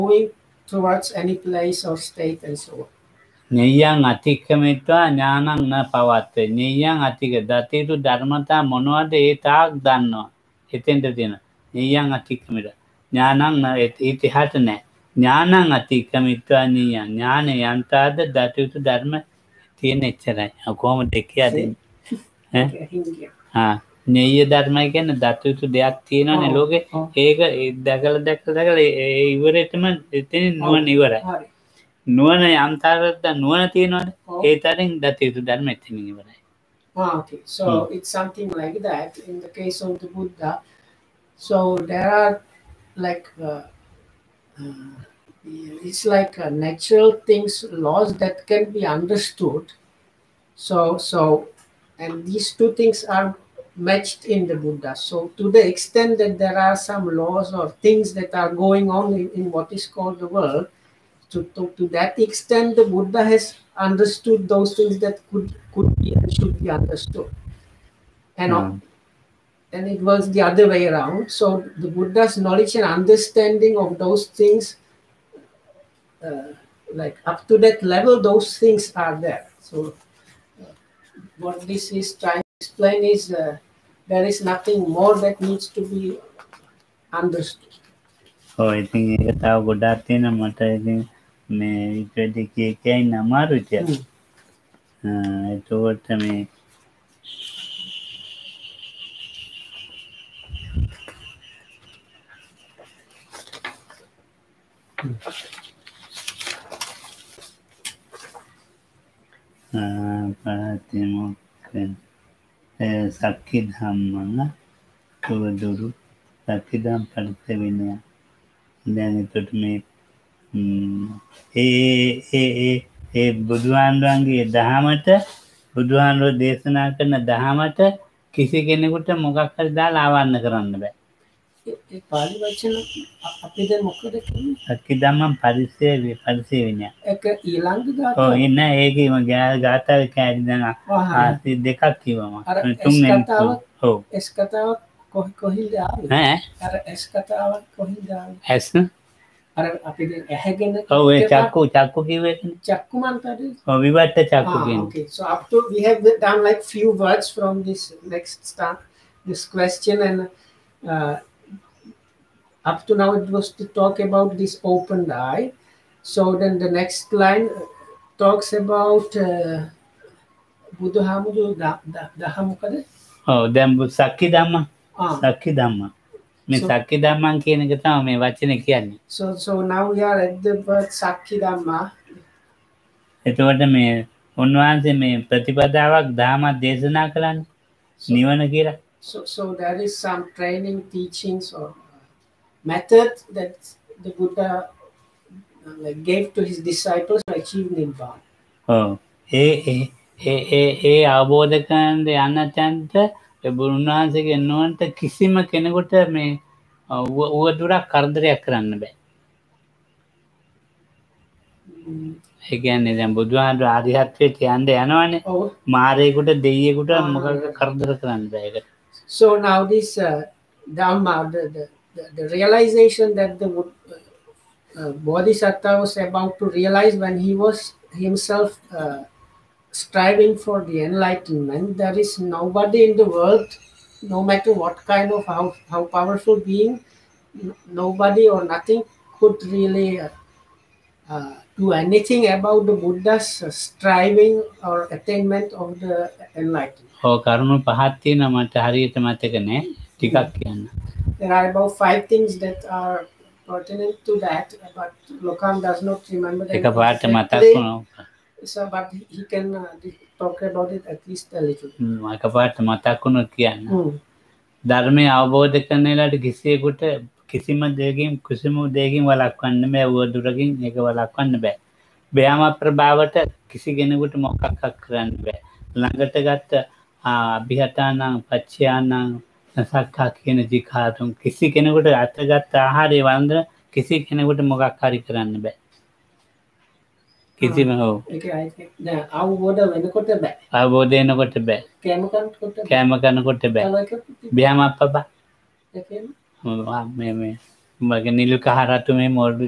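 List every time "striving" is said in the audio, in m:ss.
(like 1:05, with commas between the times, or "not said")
3:49, 4:03.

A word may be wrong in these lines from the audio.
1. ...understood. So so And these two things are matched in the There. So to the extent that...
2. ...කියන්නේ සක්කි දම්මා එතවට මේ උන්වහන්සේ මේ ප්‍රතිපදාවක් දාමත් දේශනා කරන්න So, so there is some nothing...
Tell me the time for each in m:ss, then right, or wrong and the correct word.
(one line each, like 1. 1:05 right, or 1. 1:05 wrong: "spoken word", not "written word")
1. 0:48 wrong: "Buddha", not "There"
2. 2:58 wrong: "training", not "nothing".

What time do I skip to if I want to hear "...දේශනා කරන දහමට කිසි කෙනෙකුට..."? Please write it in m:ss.
2:06.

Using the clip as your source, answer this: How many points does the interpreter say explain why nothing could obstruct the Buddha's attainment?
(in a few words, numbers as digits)
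5.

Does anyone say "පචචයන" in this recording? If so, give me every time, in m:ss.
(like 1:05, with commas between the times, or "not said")
4:38.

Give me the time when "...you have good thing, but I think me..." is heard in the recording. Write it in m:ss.
1:29.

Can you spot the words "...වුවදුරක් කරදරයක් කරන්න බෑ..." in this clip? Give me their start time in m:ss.
3:27.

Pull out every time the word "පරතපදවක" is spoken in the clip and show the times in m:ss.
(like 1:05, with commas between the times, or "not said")
3:05.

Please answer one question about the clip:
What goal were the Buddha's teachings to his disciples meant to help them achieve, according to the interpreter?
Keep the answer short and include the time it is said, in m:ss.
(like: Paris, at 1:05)
Nibbana, at 3:17.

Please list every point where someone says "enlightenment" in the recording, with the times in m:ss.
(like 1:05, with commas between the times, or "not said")
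3:50, 4:06.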